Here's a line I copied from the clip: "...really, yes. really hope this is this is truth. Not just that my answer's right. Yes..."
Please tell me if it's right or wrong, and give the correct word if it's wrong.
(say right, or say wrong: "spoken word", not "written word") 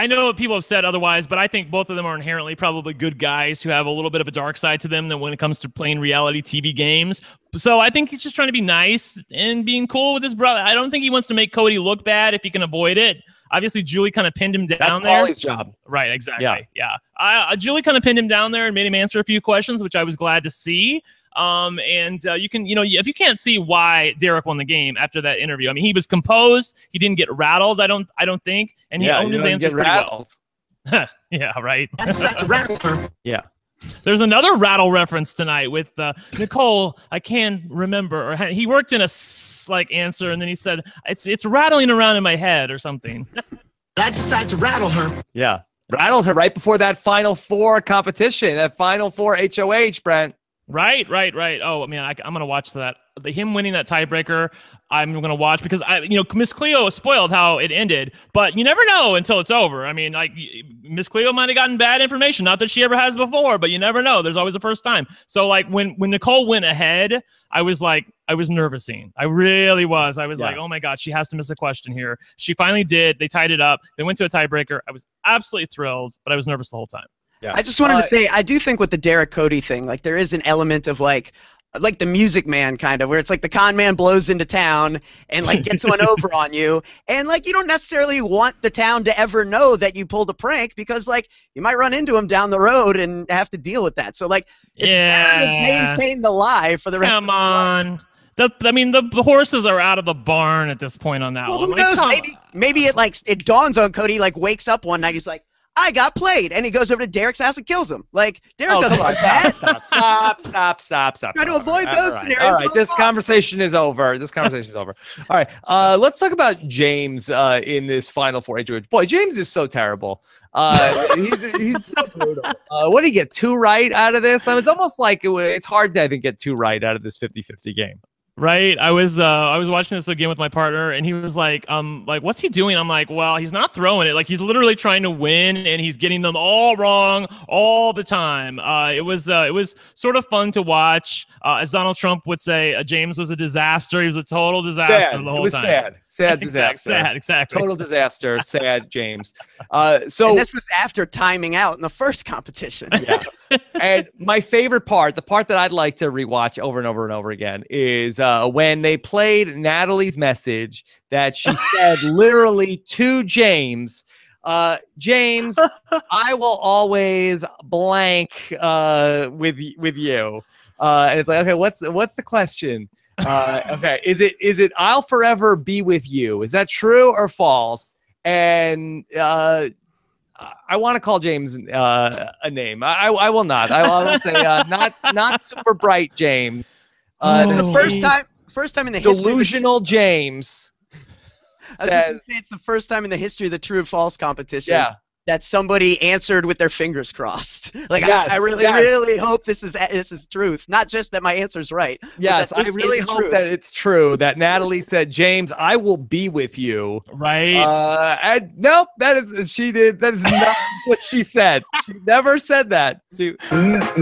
right.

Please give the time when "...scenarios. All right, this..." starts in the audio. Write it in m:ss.
1:52.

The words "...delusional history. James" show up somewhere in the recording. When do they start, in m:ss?
3:08.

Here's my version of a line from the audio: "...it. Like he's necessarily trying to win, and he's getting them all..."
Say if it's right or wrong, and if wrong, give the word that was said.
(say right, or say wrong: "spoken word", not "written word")
wrong: "literally", not "necessarily".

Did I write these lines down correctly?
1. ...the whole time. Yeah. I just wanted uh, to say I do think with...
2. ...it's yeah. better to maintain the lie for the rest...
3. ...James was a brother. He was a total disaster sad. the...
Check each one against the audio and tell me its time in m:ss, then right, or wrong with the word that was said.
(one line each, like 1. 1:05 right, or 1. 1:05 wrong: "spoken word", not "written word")
1. 1:16 right
2. 1:34 right
3. 2:22 wrong: "disaster", not "brother".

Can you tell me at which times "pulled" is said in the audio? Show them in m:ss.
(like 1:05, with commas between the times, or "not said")
1:30.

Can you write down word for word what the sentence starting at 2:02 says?
Uh, what do you get, two right out of this?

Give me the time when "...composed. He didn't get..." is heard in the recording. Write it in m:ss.
0:26.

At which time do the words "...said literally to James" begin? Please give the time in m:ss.
2:41.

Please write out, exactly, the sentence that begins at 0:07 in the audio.
So I think he's just trying to be nice and being cool with his brother.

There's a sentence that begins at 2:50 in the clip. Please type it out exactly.
Uh, and it's like, okay, what's what's the question?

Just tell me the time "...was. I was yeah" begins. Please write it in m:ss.
1:09.